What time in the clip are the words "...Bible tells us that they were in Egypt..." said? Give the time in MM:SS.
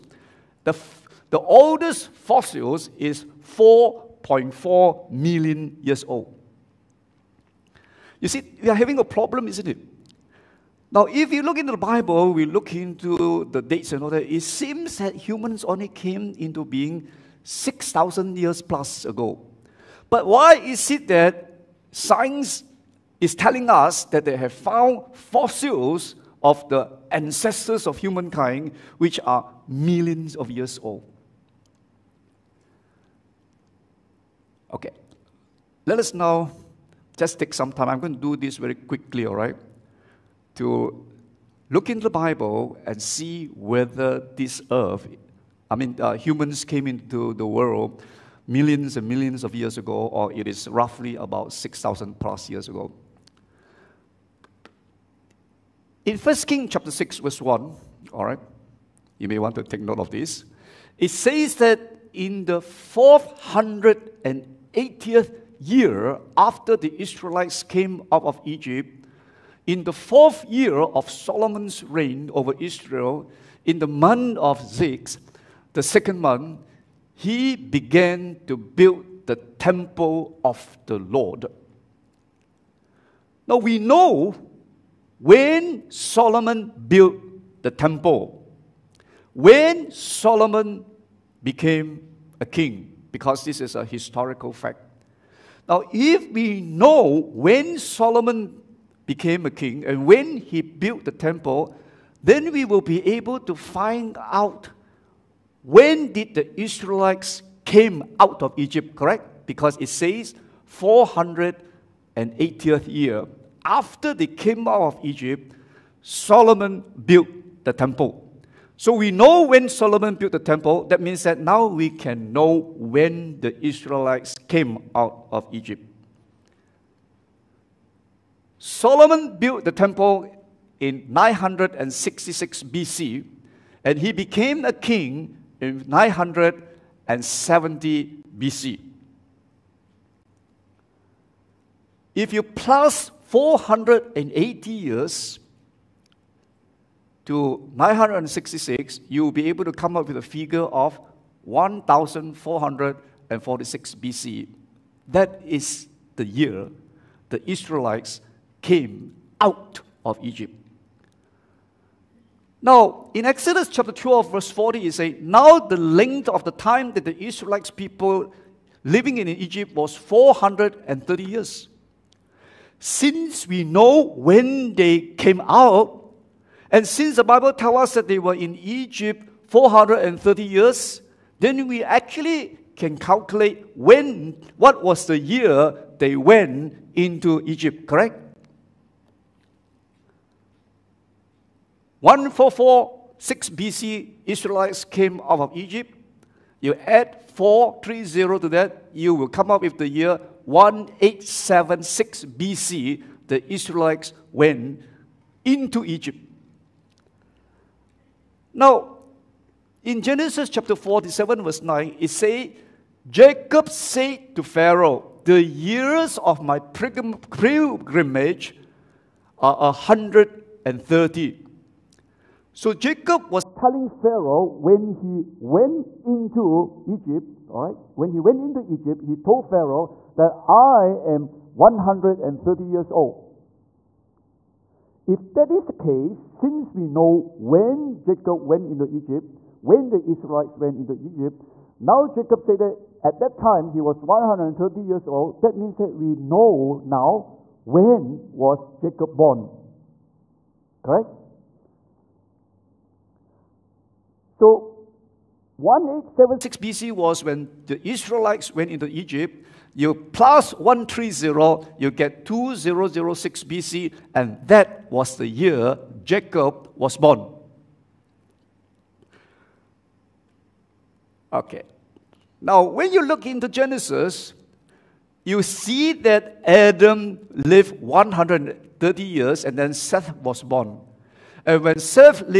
02:57.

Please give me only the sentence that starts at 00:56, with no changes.
In 1 King chapter 6, verse 1, all right, you may want to take note of this.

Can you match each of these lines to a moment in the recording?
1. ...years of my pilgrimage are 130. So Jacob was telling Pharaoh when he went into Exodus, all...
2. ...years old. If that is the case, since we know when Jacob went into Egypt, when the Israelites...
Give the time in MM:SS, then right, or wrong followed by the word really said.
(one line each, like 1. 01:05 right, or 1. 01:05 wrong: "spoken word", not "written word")
1. 03:35 wrong: "Egypt", not "Exodus"
2. 03:52 right.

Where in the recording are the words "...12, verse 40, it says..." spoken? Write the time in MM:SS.
02:43.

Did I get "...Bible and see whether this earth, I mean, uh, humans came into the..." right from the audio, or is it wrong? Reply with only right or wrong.
right.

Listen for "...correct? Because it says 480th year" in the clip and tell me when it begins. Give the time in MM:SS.
01:48.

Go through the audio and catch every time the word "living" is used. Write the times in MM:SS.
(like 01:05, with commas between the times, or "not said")
02:48.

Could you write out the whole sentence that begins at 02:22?
If you plus 480 years to 966, you will be able to come up with a figure of 1446 BC.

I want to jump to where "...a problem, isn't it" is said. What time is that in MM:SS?
00:08.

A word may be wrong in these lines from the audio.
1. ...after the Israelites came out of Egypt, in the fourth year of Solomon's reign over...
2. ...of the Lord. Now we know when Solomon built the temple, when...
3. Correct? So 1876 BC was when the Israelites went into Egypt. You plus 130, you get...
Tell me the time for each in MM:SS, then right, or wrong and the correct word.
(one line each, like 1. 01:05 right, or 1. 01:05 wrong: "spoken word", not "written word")
1. 01:06 right
2. 01:20 right
3. 04:10 right.